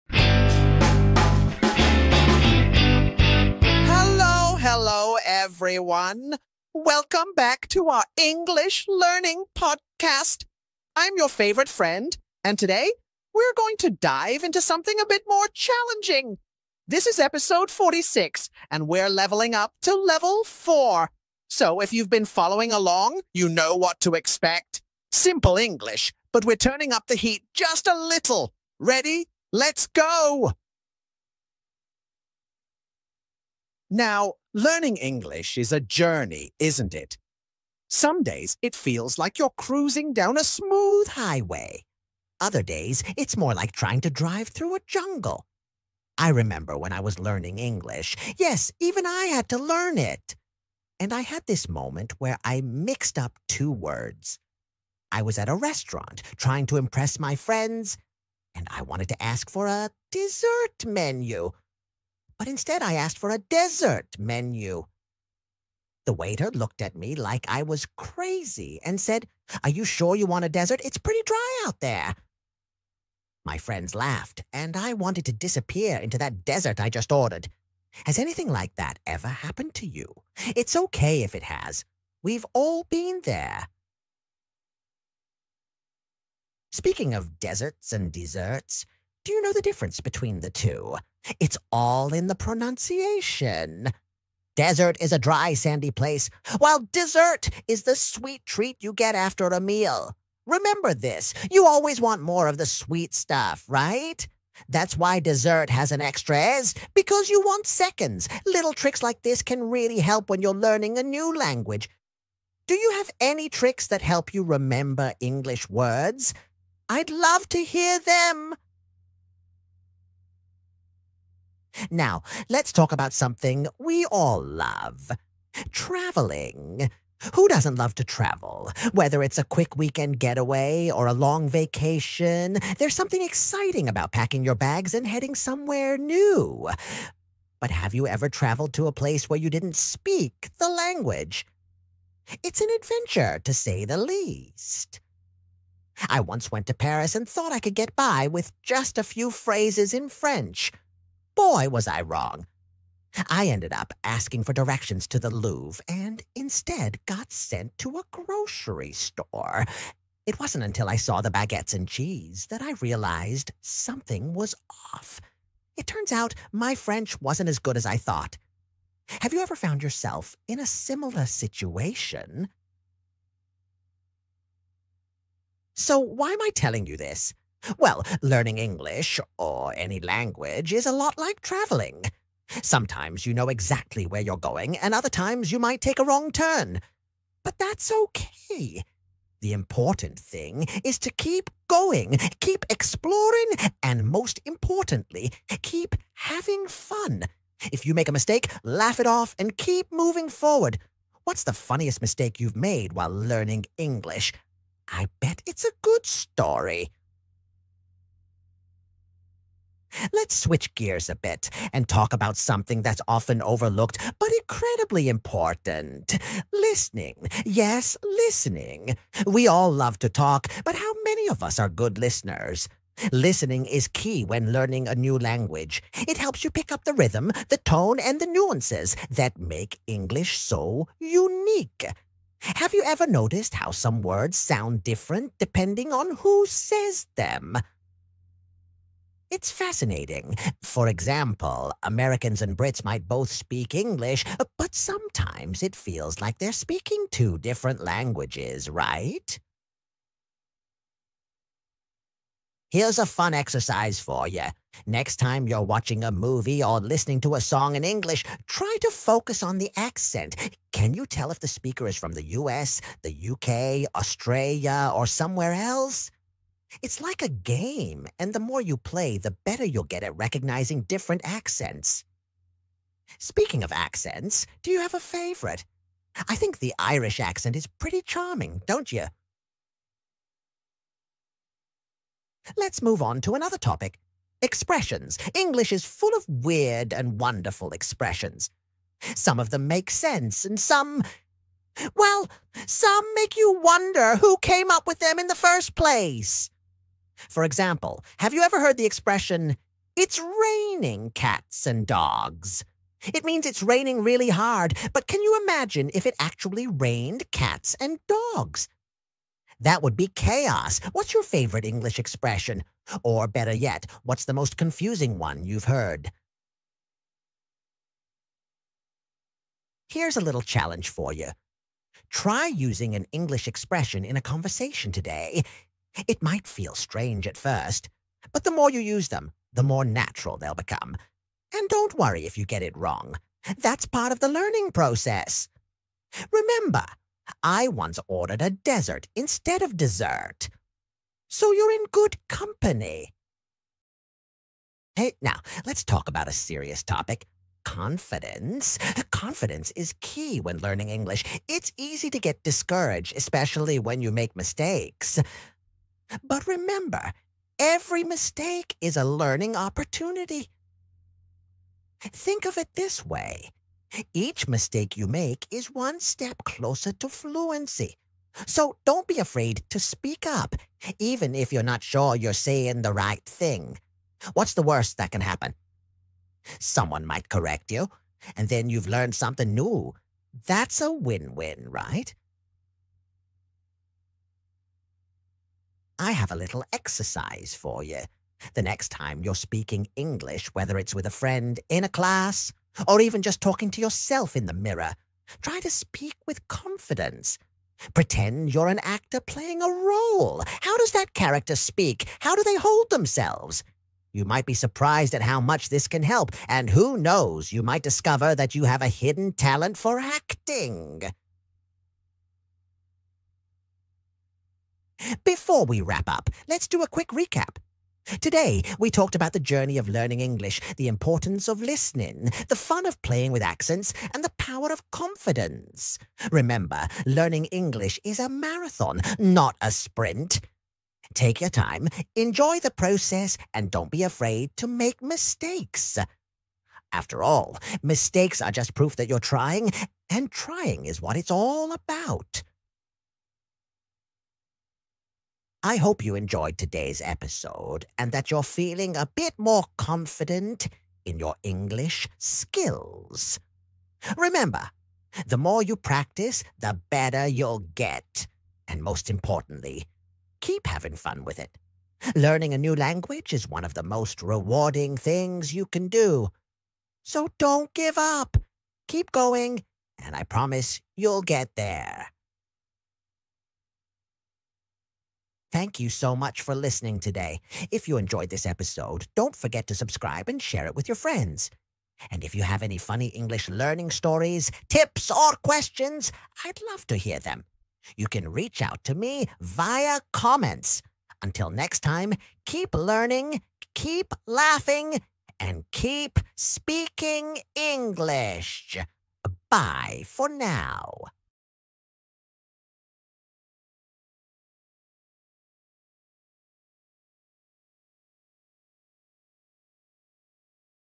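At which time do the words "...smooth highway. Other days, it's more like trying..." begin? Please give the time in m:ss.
0:40.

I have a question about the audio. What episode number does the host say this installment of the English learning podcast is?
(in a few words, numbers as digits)
46.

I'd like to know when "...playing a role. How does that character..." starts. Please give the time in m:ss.
6:39.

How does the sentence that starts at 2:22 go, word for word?
It's an adventure, to say the least.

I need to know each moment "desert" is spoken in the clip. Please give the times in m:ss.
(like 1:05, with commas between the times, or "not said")
1:10, 1:16, 1:27, 1:34, 5:38.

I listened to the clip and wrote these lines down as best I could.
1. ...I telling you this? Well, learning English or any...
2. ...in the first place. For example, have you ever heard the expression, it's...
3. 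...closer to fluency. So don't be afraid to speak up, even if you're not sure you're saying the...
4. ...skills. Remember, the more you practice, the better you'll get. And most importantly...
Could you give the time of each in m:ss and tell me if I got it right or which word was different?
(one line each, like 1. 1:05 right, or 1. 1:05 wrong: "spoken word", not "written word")
1. 2:56 right
2. 4:55 right
3. 6:06 right
4. 7:32 right.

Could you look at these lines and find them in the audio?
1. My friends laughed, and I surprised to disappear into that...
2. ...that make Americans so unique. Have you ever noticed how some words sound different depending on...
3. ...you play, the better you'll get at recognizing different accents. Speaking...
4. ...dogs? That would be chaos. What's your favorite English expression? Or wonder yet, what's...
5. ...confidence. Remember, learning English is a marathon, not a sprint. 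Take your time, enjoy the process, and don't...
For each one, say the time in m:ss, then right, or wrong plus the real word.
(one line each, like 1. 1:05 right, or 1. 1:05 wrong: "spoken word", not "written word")
1. 1:13 wrong: "wanted", not "surprised"
2. 3:49 wrong: "English", not "Americans"
3. 4:28 right
4. 5:08 wrong: "better", not "wonder"
5. 7:04 right.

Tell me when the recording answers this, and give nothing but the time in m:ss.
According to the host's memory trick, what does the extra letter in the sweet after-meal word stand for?
1:47.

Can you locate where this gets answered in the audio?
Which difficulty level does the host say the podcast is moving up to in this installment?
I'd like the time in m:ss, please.
0:19.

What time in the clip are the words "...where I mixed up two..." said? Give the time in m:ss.
0:52.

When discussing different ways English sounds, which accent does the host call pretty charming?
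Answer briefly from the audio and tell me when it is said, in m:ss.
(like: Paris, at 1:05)
Irish, at 4:36.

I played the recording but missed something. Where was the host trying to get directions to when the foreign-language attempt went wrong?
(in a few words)
The Louvre.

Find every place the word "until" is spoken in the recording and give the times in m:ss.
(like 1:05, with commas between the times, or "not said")
2:40, 8:11.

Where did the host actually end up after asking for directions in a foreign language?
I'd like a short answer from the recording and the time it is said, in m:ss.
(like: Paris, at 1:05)
A grocery store, at 2:38.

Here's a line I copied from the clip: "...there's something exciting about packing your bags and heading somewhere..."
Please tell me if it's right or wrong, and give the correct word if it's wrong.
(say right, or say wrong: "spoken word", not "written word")
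right.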